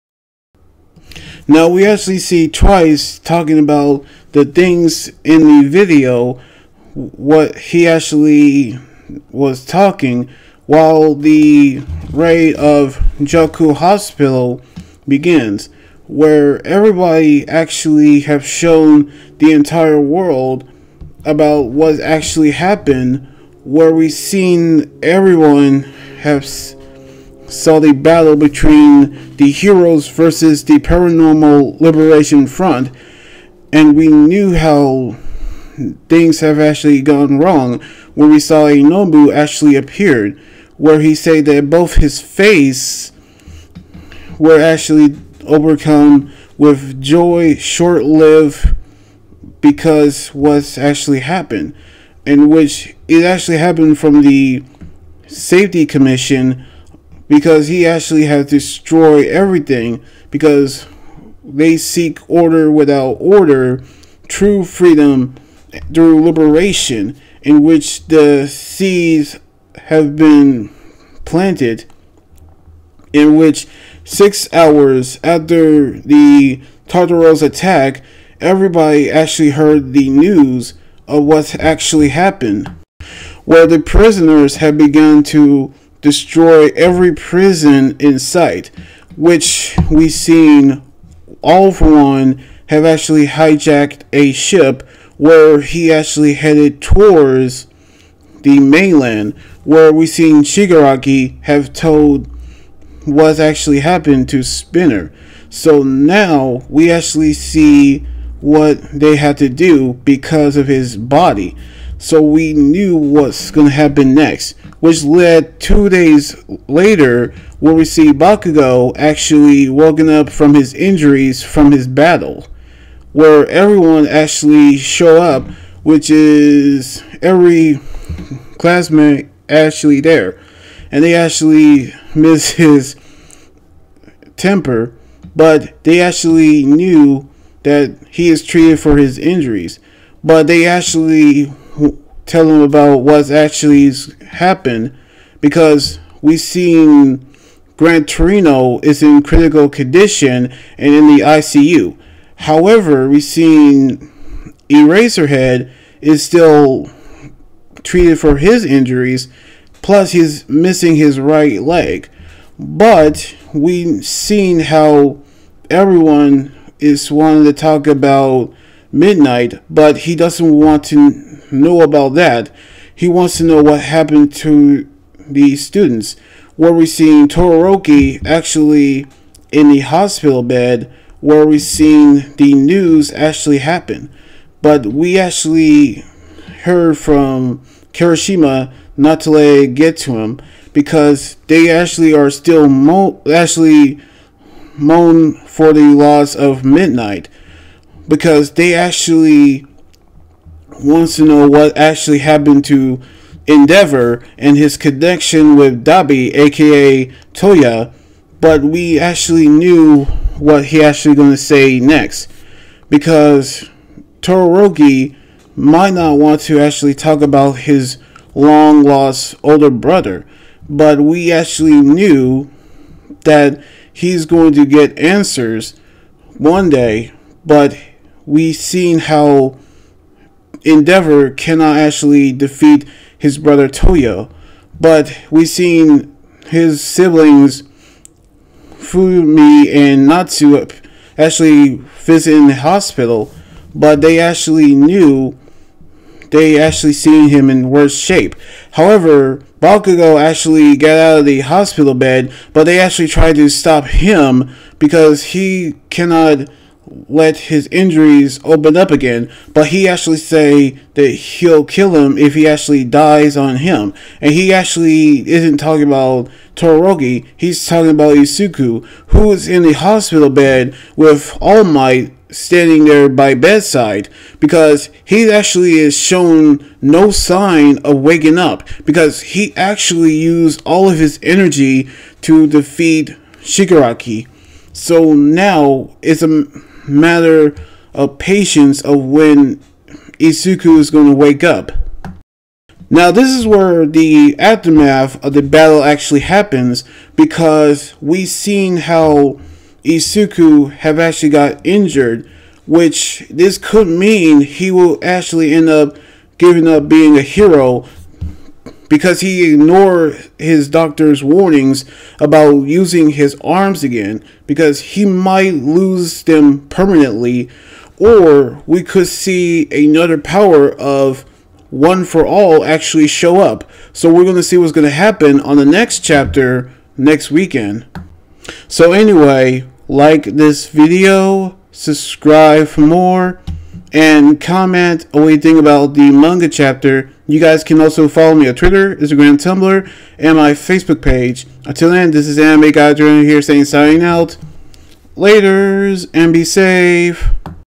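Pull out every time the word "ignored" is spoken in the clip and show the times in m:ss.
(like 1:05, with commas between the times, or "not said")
5:09.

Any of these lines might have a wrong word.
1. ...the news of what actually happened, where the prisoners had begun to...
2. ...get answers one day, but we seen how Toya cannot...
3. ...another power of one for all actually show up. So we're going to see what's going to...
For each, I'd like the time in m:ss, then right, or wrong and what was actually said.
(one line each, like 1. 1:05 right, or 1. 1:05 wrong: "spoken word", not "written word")
1. 1:19 right
2. 3:44 wrong: "Endeavor", not "Toya"
3. 5:19 right.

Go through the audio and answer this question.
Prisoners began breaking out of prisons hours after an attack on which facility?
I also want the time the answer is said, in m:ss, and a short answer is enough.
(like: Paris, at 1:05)
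Tartaros, at 1:16.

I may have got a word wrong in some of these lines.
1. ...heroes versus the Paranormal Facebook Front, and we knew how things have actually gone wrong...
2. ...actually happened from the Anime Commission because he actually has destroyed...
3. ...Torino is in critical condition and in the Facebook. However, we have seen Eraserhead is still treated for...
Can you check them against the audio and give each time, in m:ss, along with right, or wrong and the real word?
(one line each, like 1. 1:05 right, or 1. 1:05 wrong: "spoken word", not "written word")
1. 0:29 wrong: "Liberation", not "Facebook"
2. 0:53 wrong: "Safety", not "Anime"
3. 2:28 wrong: "ICU", not "Facebook".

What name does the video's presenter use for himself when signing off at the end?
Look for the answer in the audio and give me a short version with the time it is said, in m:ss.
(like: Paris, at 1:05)
Anime Guy Jordan, at 5:42.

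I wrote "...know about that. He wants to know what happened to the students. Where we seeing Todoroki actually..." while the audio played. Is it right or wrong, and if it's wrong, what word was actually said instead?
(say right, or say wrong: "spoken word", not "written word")
right.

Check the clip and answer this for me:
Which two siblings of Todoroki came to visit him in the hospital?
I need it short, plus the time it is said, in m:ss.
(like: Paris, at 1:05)
Fumi and Natsu, at 3:58.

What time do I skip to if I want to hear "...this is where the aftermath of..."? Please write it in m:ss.
4:53.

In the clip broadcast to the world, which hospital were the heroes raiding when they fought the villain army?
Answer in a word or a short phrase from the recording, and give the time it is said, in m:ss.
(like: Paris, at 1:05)
Jaku Hospital, at 0:13.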